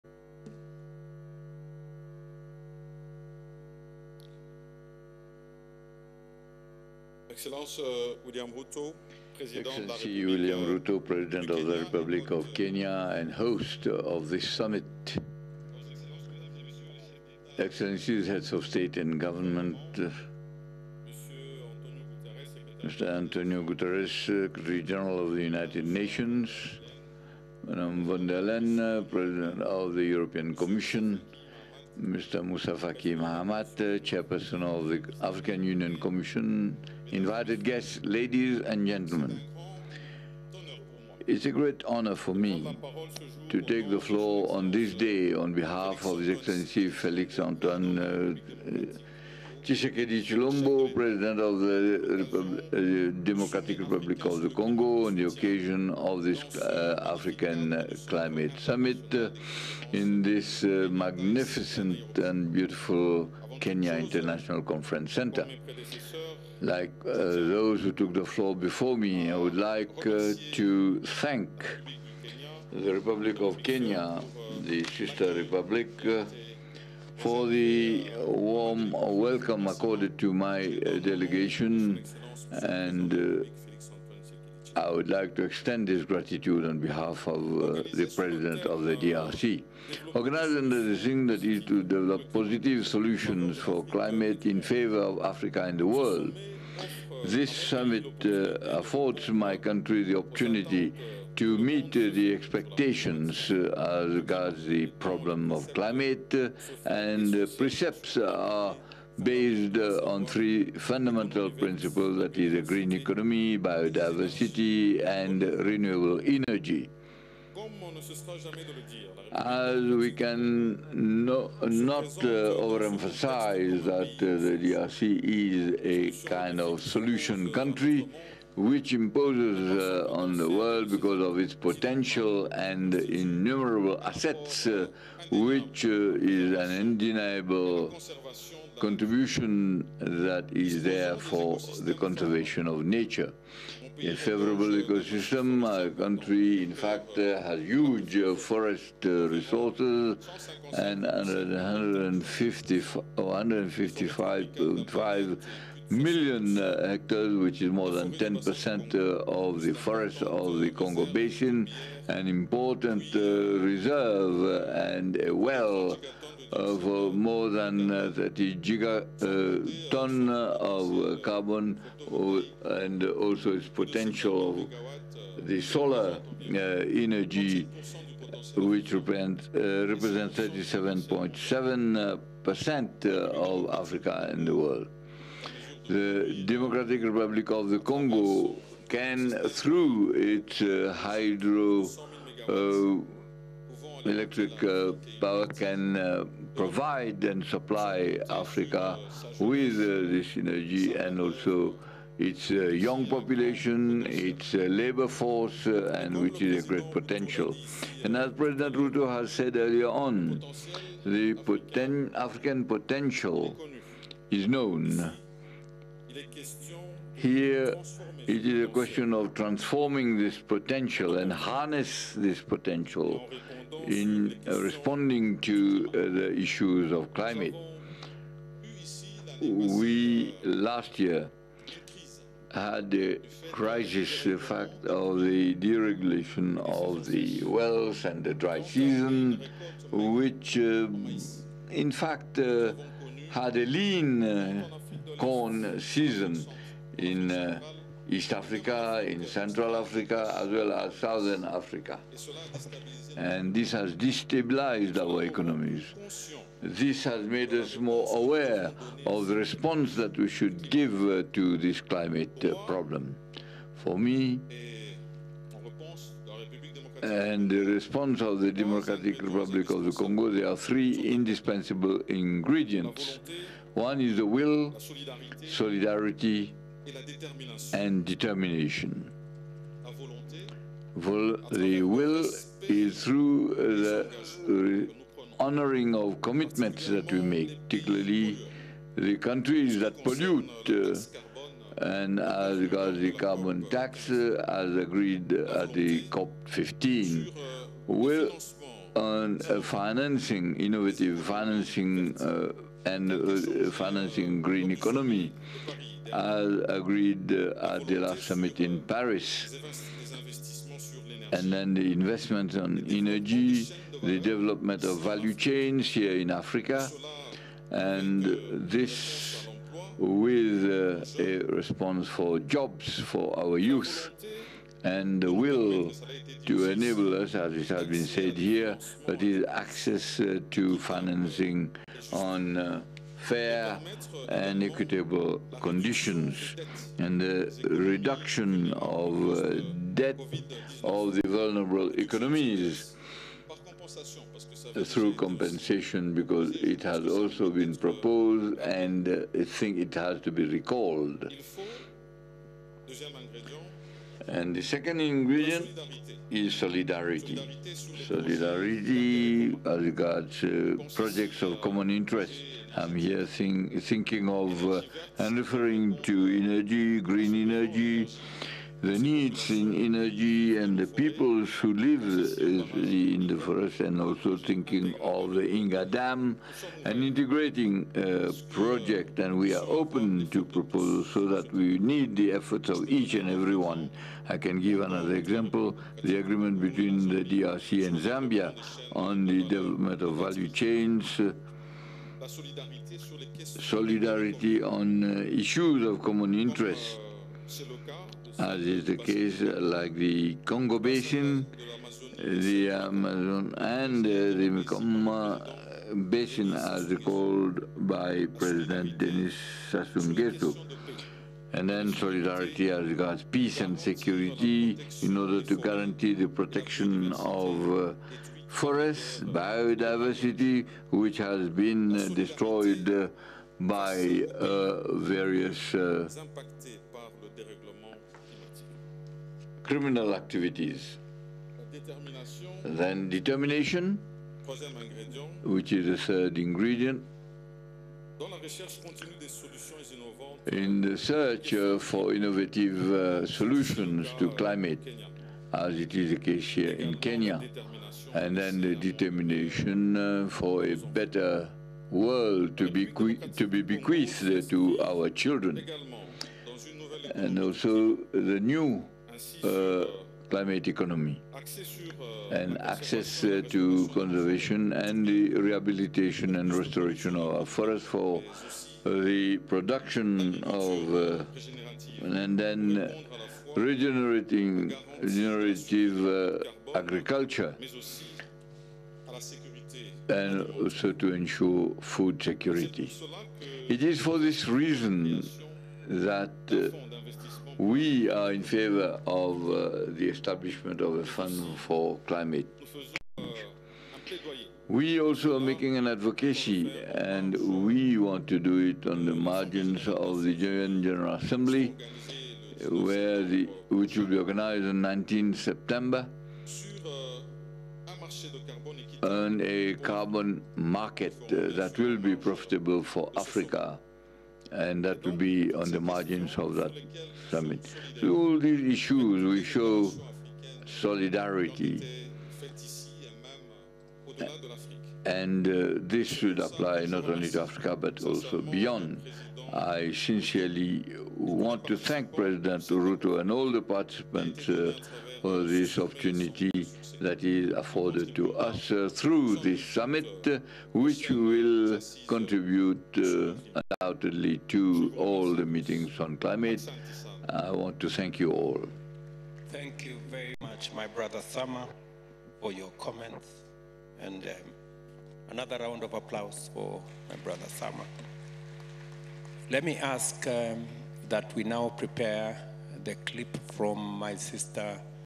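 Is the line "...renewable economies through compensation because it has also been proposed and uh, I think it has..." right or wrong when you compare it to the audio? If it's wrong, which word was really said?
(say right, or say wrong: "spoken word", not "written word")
wrong: "vulnerable", not "renewable".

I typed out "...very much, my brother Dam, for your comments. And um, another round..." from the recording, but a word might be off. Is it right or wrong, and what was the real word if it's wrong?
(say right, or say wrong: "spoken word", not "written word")
wrong: "Sama", not "Dam".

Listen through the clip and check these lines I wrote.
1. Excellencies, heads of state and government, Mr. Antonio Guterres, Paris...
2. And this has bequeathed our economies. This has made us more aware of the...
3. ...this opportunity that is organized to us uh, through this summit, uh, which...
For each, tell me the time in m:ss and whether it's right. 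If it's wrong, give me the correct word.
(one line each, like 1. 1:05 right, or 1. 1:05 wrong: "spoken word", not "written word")
1. 0:17 wrong: "Secretary", not "Paris"
2. 4:13 wrong: "destabilized", not "bequeathed"
3. 8:55 wrong: "afforded", not "organized".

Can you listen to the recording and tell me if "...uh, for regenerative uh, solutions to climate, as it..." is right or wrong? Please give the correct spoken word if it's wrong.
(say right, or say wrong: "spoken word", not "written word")
wrong: "innovative", not "regenerative".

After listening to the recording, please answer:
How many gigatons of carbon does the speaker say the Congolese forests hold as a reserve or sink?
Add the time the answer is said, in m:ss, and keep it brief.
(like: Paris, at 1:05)
30, at 2:48.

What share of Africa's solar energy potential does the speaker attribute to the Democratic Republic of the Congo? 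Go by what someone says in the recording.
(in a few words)
37.7%.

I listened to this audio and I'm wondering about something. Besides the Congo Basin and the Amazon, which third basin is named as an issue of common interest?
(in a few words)
Mekong Basin.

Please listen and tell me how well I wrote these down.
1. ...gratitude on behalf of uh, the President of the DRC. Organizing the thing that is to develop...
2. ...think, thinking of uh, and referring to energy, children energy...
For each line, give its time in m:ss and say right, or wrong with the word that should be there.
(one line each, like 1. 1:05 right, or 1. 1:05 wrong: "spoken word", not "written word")
1. 1:26 right
2. 6:03 wrong: "green", not "children".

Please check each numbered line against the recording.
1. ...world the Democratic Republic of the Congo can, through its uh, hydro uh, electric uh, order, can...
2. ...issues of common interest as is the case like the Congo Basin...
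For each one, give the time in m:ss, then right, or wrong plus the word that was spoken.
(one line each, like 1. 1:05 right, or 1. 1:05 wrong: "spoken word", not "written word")
1. 3:04 wrong: "power", not "order"
2. 6:35 right.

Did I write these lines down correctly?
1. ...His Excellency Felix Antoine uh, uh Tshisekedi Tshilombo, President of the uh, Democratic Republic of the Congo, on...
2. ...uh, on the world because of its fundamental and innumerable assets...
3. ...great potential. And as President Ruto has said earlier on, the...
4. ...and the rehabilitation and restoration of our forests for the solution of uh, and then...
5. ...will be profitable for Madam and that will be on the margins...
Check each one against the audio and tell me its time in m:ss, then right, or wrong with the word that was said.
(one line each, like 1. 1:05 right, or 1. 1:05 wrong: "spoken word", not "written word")
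1. 0:46 right
2. 2:09 wrong: "potential", not "fundamental"
3. 3:26 right
4. 7:44 wrong: "production", not "solution"
5. 8:31 wrong: "Africa", not "Madam".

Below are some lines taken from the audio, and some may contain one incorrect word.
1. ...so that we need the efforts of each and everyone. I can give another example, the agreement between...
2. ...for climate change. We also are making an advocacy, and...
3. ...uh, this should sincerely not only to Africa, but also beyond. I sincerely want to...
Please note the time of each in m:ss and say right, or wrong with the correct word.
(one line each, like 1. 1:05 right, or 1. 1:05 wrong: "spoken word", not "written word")
1. 6:21 right
2. 8:11 right
3. 8:45 wrong: "apply", not "sincerely".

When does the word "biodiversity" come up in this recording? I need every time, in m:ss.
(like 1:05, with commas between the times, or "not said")
1:53, 6:59.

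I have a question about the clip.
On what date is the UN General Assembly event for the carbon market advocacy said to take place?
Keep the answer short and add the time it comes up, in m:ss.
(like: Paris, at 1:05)
19 September, at 8:24.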